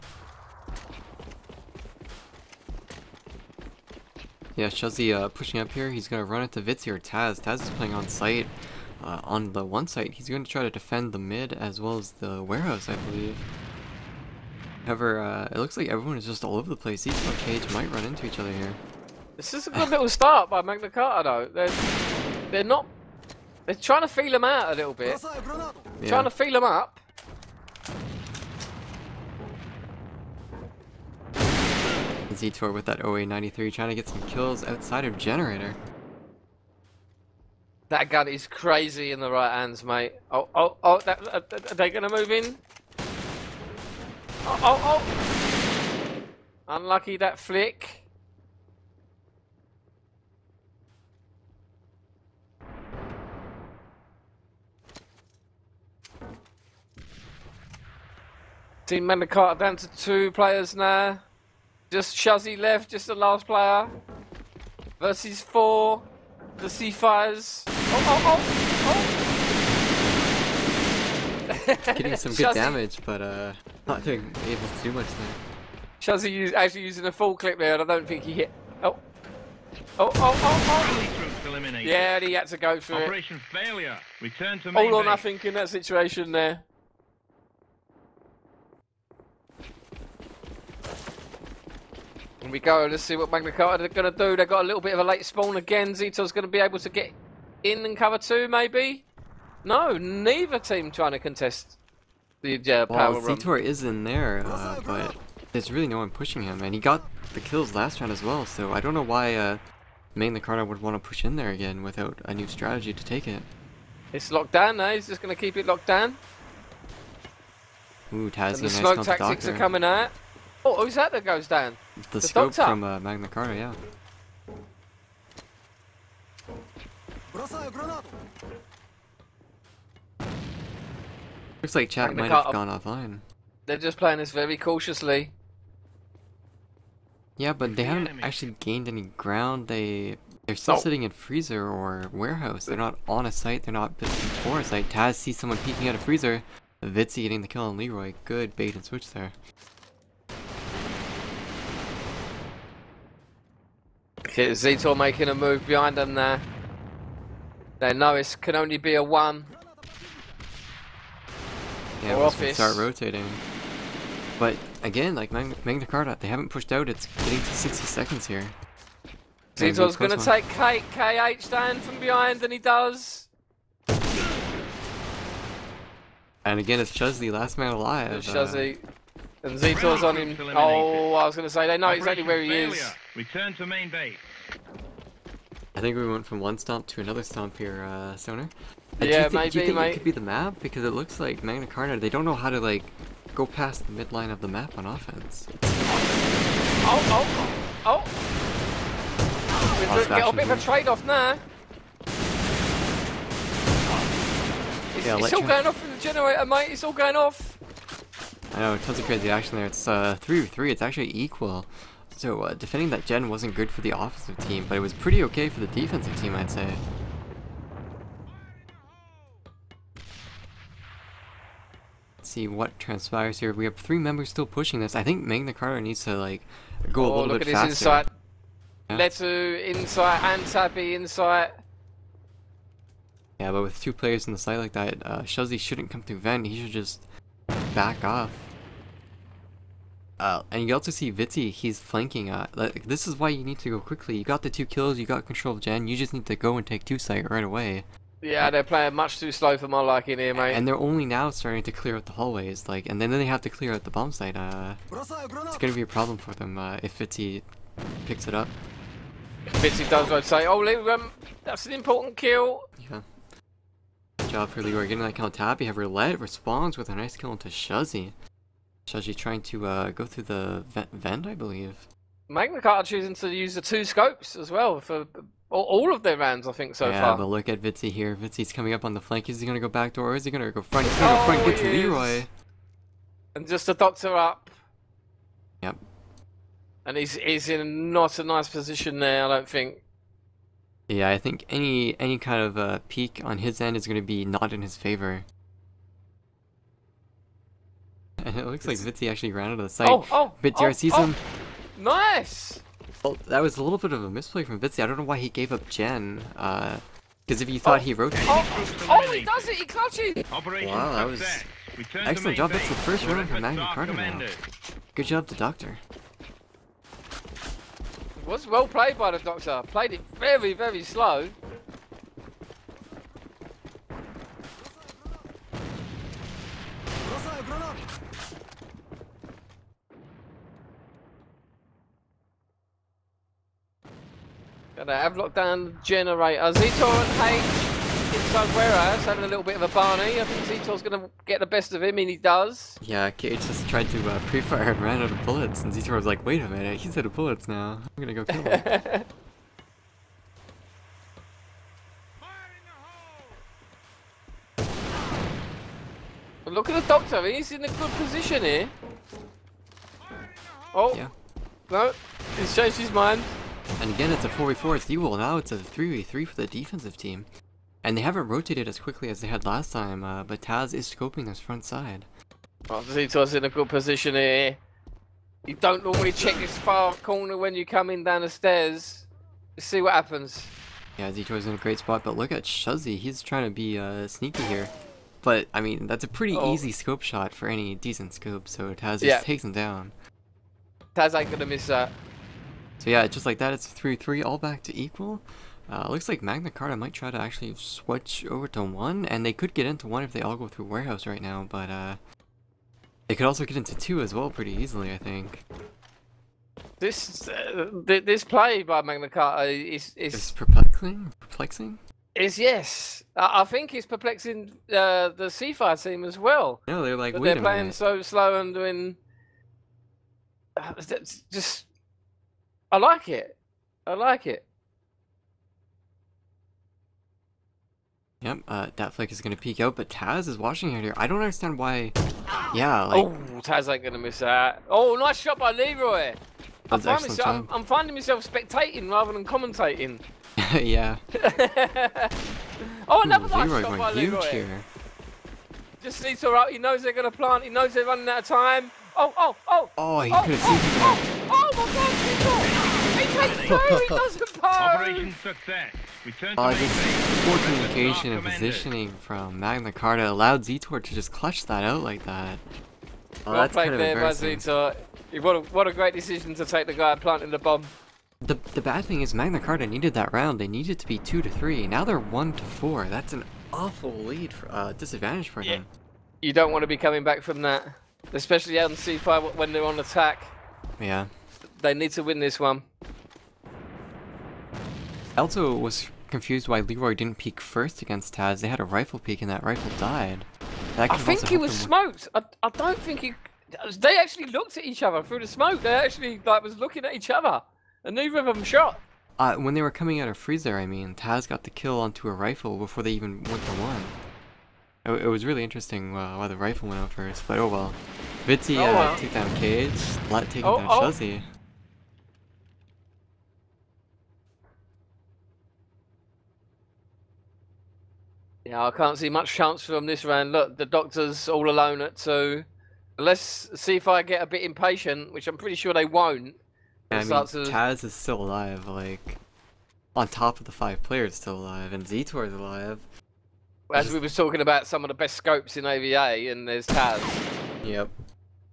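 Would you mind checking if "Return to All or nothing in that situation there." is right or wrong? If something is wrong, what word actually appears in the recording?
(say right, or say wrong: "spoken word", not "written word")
right.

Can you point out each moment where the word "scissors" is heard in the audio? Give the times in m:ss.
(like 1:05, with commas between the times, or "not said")
not said.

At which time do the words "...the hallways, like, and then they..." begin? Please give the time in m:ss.
4:12.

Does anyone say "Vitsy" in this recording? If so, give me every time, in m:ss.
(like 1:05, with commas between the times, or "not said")
8:28.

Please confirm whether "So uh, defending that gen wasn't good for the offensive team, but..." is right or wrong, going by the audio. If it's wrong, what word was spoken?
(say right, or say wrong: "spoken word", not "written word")
right.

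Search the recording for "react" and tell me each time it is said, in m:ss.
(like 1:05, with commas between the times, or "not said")
not said.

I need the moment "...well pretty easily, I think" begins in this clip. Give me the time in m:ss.
6:44.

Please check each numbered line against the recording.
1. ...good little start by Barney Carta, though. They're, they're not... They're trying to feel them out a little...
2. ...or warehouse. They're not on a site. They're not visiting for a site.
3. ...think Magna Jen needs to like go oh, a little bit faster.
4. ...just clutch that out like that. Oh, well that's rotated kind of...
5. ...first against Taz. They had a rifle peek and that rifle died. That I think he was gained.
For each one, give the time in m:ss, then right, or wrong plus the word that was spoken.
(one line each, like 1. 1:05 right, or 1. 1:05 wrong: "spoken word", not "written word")
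1. 0:19 wrong: "Magna", not "Barney"
2. 2:21 right
3. 3:45 wrong: "Carta", not "Jen"
4. 7:40 wrong: "played", not "rotated"
5. 8:07 wrong: "smoked", not "gained".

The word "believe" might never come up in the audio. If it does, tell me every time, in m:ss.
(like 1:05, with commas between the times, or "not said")
0:12, 4:31.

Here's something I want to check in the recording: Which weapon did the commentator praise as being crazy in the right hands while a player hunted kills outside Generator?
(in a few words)
OA93.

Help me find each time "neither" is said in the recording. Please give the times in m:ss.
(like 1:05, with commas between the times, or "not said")
1:39, 8:17.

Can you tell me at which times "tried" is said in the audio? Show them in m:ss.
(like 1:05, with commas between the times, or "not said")
5:43.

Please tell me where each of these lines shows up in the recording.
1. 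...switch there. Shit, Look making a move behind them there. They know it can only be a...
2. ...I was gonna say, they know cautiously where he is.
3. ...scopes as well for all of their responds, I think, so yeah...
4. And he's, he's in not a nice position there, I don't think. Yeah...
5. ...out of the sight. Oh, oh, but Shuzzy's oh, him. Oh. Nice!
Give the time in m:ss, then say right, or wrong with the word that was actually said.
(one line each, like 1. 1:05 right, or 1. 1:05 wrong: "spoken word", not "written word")
1. 2:28 wrong: "Zito", not "Look"
2. 3:01 wrong: "exactly", not "cautiously"
3. 4:33 wrong: "rounds", not "responds"
4. 4:46 right
5. 4:59 wrong: "DRC", not "Shuzzy".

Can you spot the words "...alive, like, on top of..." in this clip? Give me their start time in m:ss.
8:48.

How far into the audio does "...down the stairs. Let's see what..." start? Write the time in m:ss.
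6:18.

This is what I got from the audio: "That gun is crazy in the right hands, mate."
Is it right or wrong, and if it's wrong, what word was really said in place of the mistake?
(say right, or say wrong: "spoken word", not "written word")
right.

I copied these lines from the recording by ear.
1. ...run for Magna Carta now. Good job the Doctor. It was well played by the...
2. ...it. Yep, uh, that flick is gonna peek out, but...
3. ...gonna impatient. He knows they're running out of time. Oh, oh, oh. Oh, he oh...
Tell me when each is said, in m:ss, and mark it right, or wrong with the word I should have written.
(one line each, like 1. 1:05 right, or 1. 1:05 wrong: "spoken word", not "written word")
1. 5:13 right
2. 7:04 right
3. 7:26 wrong: "plant", not "impatient".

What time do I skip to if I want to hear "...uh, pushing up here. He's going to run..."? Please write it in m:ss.
0:05.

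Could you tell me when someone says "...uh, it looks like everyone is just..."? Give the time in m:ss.
0:15.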